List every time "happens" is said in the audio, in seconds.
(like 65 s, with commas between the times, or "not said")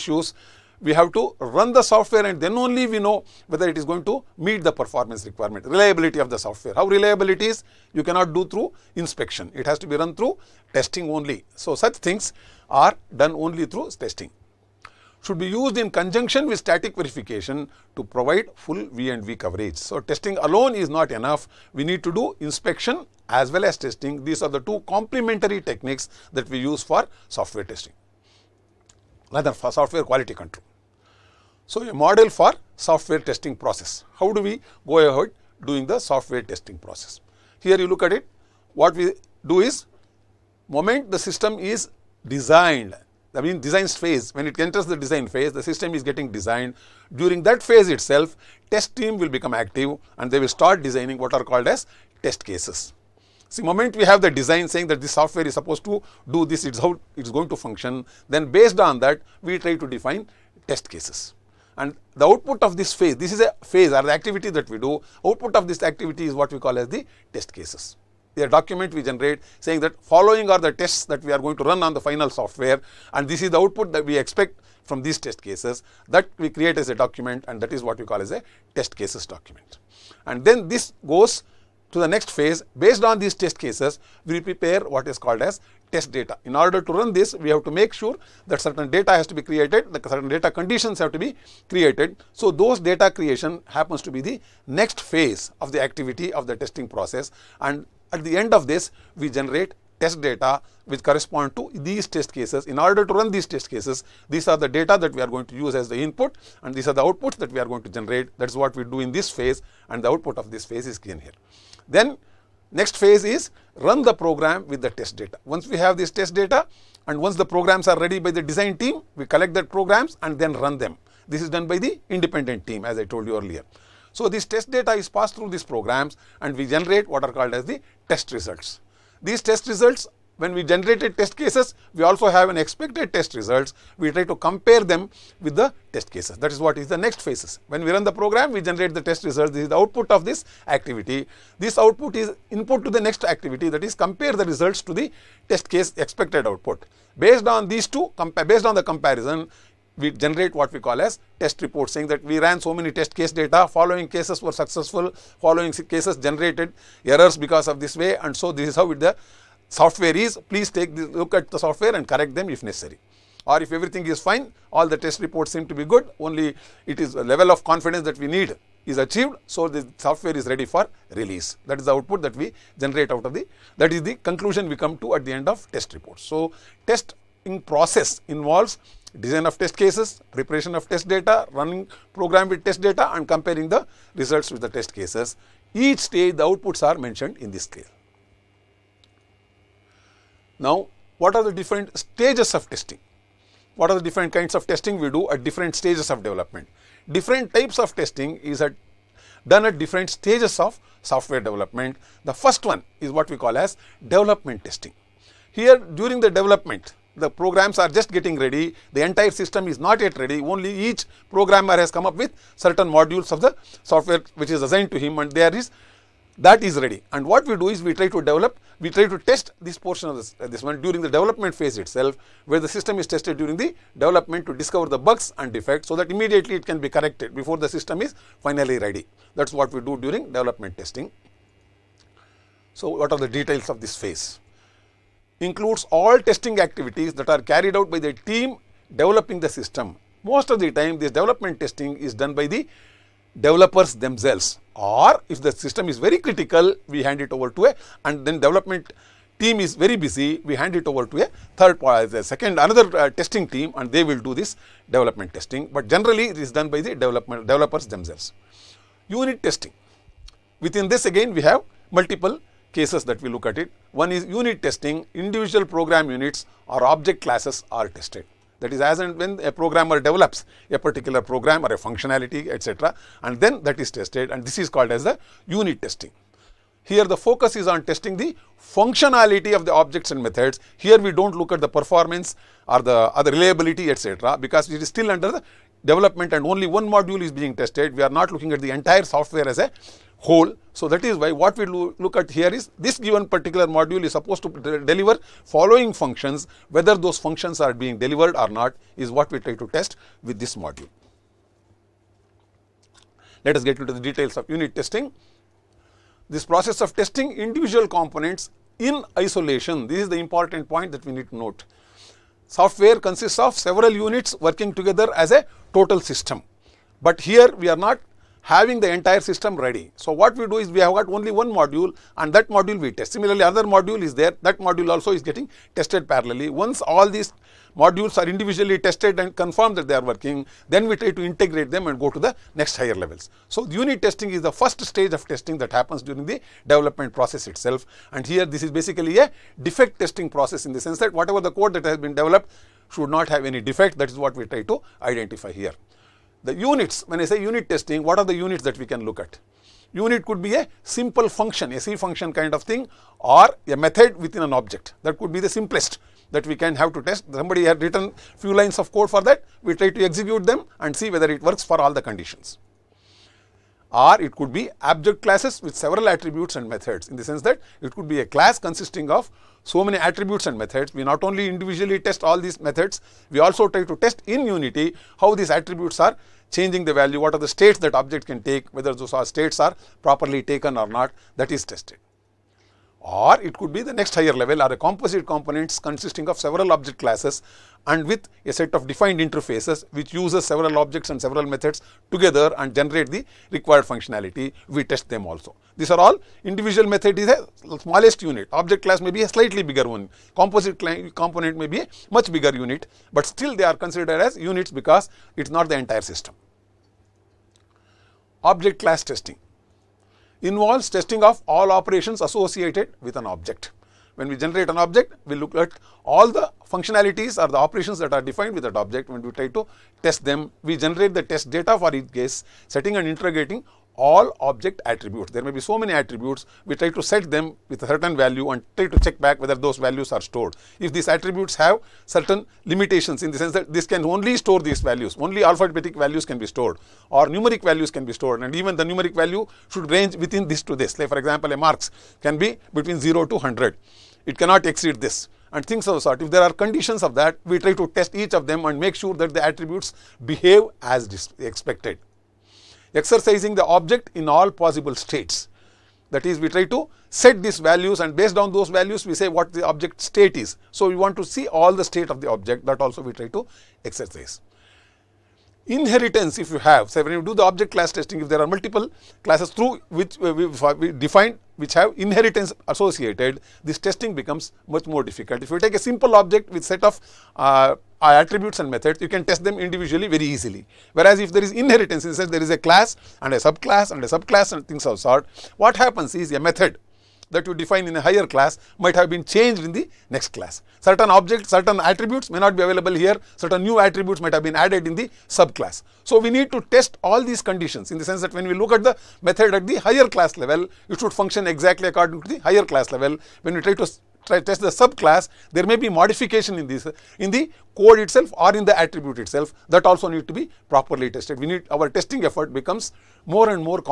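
93 s, 335 s, 485 s.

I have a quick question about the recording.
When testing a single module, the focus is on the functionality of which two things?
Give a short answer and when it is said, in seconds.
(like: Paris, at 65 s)
Objects and methods, at 279 s.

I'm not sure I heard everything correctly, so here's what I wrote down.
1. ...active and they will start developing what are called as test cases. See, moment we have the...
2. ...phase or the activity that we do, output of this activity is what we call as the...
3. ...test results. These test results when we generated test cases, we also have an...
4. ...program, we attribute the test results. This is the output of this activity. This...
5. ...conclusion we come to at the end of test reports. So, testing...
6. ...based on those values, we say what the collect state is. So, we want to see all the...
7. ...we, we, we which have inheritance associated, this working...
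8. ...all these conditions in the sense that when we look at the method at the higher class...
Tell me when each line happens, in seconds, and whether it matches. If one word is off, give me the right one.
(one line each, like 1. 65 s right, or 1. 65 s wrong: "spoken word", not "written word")
1. 49 s wrong: "designing", not "developing"
2. 63 s right
3. 128 s right
4. 138 s wrong: "generate", not "attribute"
5. 174 s right
6. 458 s wrong: "object", not "collect"
7. 470 s wrong: "testing", not "working"
8. 497 s right.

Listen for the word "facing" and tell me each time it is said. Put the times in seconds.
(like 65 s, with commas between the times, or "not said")
not said.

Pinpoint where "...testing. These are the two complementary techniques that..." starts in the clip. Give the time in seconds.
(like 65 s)
23 s.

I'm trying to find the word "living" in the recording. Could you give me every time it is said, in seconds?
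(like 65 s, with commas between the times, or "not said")
not said.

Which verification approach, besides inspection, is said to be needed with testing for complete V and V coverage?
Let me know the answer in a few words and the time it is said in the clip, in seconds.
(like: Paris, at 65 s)
Static verification, at 16 s.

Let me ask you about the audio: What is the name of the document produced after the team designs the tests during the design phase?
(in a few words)
Test cases document.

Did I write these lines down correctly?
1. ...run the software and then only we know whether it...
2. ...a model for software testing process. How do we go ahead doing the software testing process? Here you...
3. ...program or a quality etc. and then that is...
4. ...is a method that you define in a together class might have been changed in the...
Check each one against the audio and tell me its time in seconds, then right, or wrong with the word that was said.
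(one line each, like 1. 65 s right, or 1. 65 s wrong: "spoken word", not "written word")
1. 1 s right
2. 31 s right
3. 271 s wrong: "functionality", not "quality"
4. 486 s wrong: "higher", not "together".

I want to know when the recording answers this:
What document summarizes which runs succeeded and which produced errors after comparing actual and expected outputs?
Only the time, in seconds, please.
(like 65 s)
151 s.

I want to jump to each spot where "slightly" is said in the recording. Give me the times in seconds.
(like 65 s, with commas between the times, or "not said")
399 s.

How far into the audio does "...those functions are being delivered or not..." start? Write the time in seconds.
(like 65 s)
296 s.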